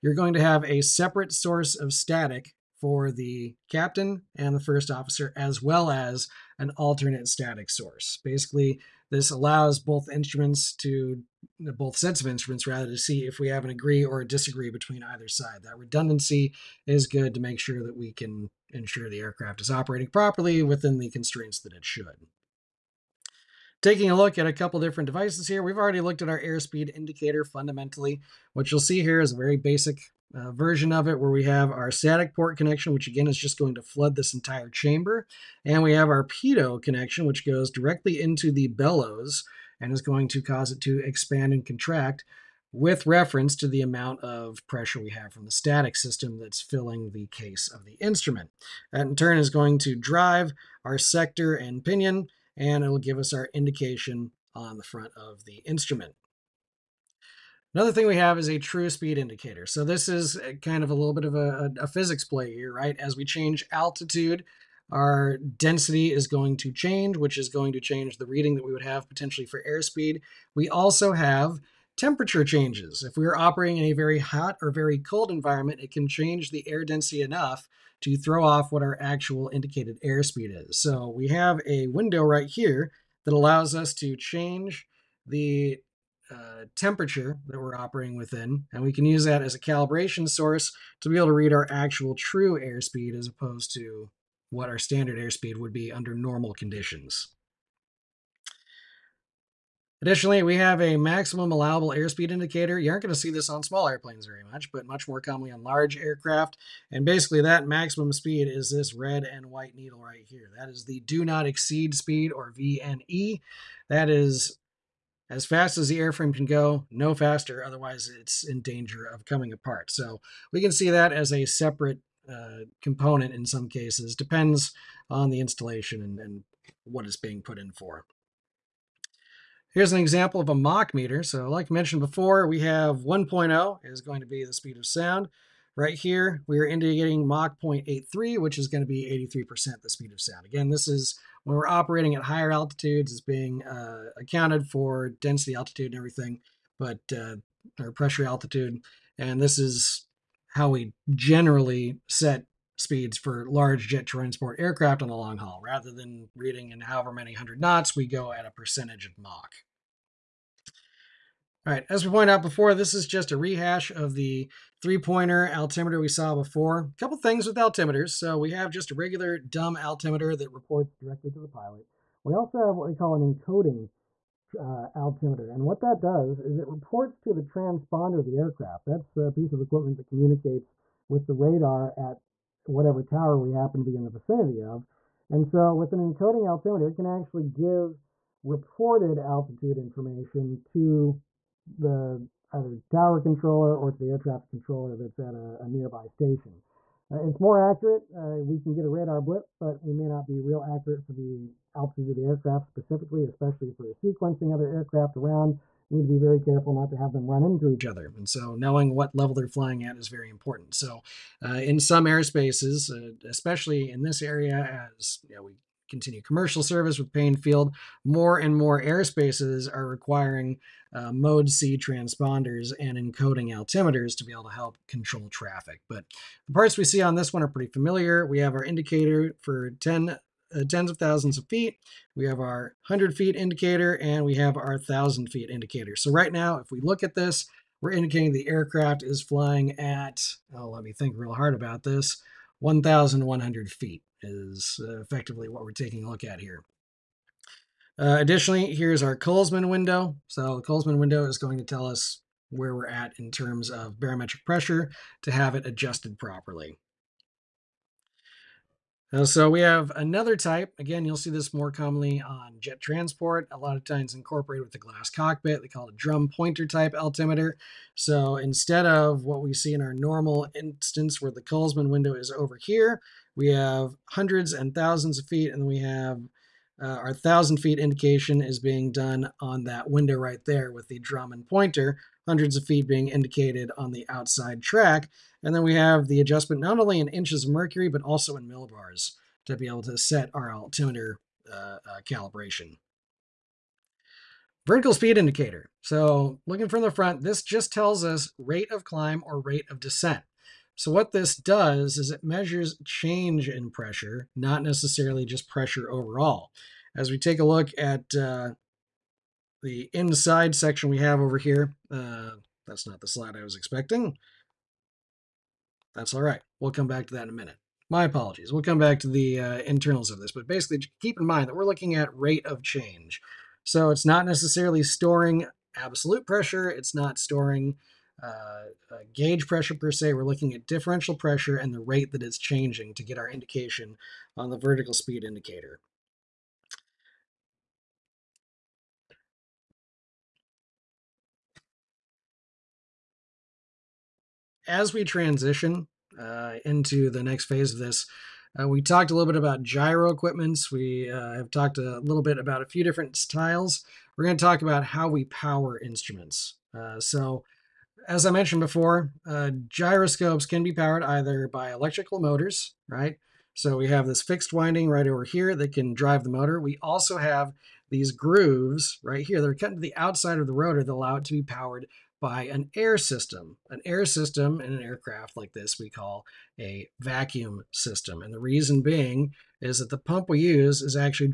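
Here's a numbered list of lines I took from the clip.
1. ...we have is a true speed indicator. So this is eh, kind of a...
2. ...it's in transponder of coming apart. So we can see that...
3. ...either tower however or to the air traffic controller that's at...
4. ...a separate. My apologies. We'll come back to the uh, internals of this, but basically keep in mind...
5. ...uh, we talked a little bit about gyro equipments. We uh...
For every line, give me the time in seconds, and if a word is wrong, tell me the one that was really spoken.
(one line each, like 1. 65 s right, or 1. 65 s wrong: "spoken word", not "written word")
1. 58 s right
2. 118 s wrong: "danger", not "transponder"
3. 192 s wrong: "controller", not "however"
4. 317 s wrong: "minute", not "separate"
5. 348 s right.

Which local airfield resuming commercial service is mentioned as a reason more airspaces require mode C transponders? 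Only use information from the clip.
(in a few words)
Payne Field.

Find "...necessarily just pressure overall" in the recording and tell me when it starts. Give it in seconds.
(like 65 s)
304 s.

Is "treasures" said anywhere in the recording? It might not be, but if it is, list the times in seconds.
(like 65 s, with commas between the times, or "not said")
not said.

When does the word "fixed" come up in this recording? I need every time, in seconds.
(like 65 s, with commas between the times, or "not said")
364 s.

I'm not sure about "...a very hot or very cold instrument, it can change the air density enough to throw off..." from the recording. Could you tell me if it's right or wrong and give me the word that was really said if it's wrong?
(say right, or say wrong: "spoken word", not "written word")
wrong: "environment", not "instrument".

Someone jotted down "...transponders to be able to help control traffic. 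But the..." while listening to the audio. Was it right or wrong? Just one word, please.
wrong.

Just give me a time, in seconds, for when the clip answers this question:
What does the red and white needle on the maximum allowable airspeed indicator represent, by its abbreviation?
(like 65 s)
112 s.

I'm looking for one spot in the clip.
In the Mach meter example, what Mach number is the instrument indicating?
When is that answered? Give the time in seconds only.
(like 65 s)
137 s.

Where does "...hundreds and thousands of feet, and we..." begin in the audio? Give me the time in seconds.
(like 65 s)
274 s.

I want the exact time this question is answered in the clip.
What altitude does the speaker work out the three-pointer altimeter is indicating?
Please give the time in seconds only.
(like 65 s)
242 s.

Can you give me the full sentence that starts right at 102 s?
You aren't going to see this on small airplanes very much, but much more commonly on large aircraft.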